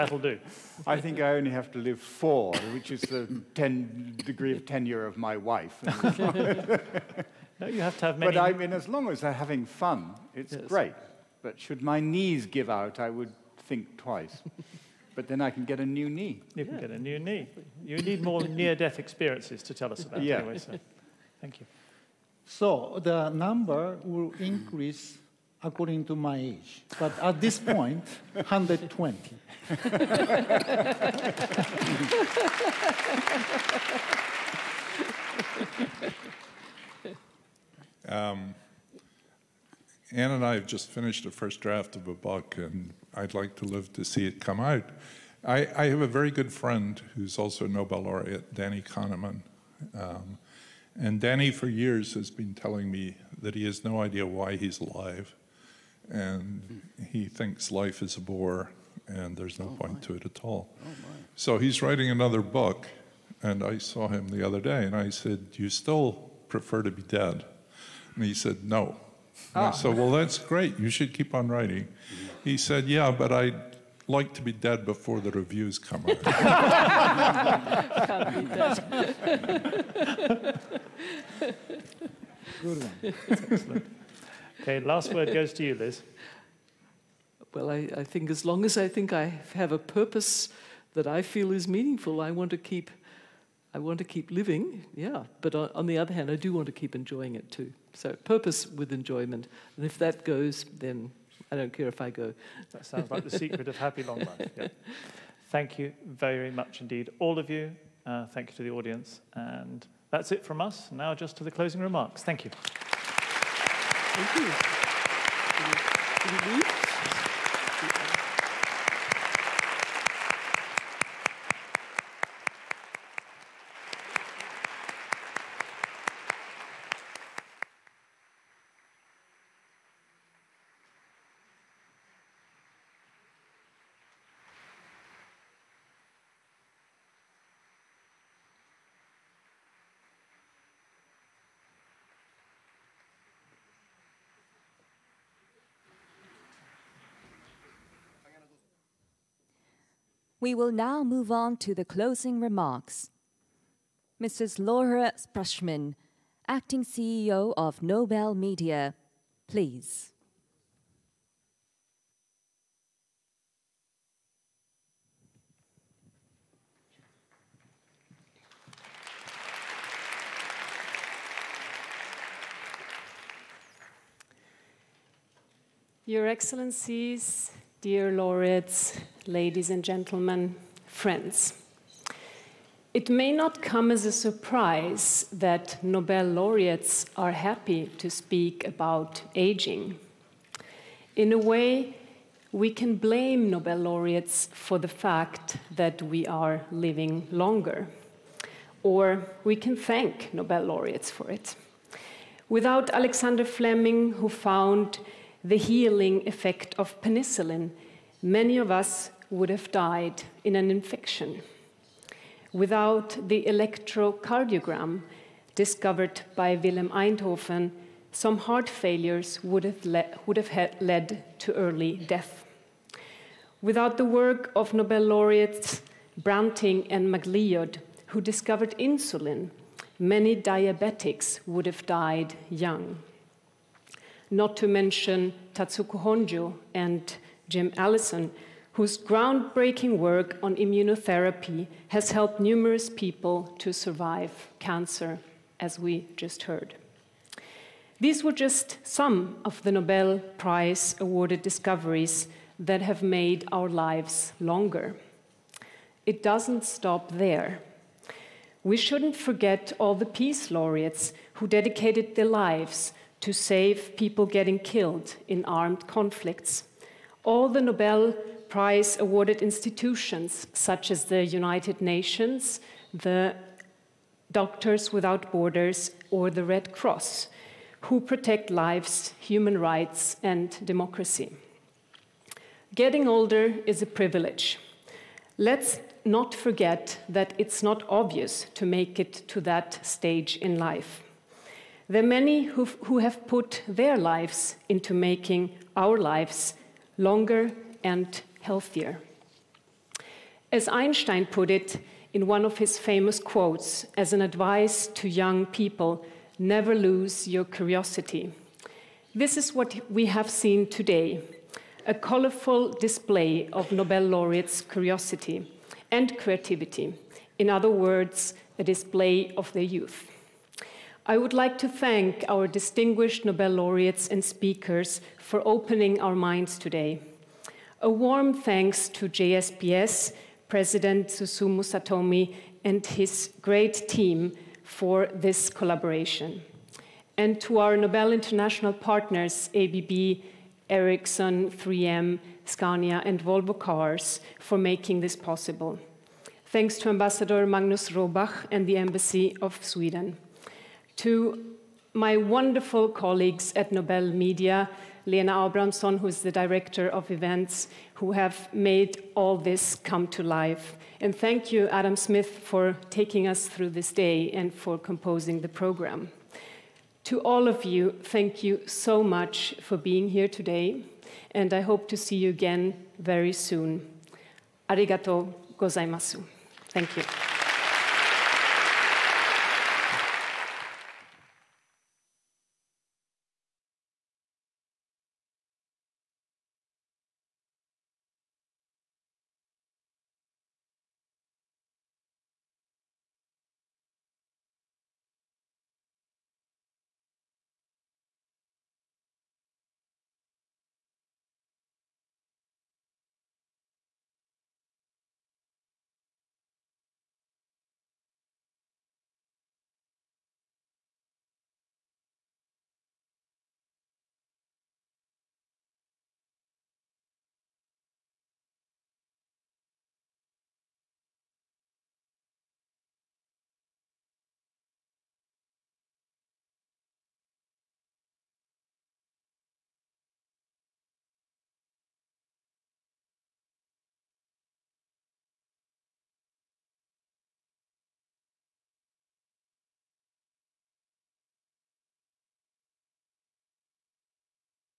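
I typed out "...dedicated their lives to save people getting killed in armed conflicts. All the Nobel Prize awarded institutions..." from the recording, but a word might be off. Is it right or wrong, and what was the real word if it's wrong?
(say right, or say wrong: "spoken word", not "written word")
right.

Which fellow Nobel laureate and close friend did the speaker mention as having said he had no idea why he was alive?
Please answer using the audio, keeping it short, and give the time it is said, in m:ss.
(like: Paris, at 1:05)
Danny Kahneman, at 0:48.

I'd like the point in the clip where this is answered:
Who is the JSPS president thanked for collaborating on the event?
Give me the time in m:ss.
5:31.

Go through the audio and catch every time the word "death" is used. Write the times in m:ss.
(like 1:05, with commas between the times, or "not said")
0:18, 3:41.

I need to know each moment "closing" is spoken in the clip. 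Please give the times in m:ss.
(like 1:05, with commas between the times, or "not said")
1:51, 2:31.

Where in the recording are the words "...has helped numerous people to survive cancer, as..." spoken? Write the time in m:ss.
4:01.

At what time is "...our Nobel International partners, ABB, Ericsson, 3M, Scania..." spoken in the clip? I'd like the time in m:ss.
5:37.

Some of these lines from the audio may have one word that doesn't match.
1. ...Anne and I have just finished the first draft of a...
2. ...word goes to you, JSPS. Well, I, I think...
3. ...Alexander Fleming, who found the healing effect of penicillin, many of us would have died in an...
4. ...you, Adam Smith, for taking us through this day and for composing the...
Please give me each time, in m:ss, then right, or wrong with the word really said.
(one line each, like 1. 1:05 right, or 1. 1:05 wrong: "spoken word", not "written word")
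1. 0:40 right
2. 1:25 wrong: "Liz", not "JSPS"
3. 3:22 right
4. 6:01 right.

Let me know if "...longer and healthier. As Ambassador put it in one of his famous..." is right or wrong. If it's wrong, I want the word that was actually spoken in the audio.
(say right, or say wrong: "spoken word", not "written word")
wrong: "Einstein", not "Ambassador".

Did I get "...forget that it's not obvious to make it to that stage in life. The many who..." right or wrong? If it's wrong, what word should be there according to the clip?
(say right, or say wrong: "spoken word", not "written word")
right.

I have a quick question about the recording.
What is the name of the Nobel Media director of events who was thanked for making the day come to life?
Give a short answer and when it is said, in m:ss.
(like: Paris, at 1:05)
Lena Abramson, at 5:55.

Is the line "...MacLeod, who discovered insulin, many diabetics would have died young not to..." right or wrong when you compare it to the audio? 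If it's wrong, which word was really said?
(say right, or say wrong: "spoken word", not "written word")
right.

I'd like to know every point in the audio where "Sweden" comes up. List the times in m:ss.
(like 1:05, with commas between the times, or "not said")
5:49.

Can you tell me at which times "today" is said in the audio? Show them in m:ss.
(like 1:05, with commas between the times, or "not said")
5:10, 5:26, 6:10.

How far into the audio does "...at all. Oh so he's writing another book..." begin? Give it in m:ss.
1:00.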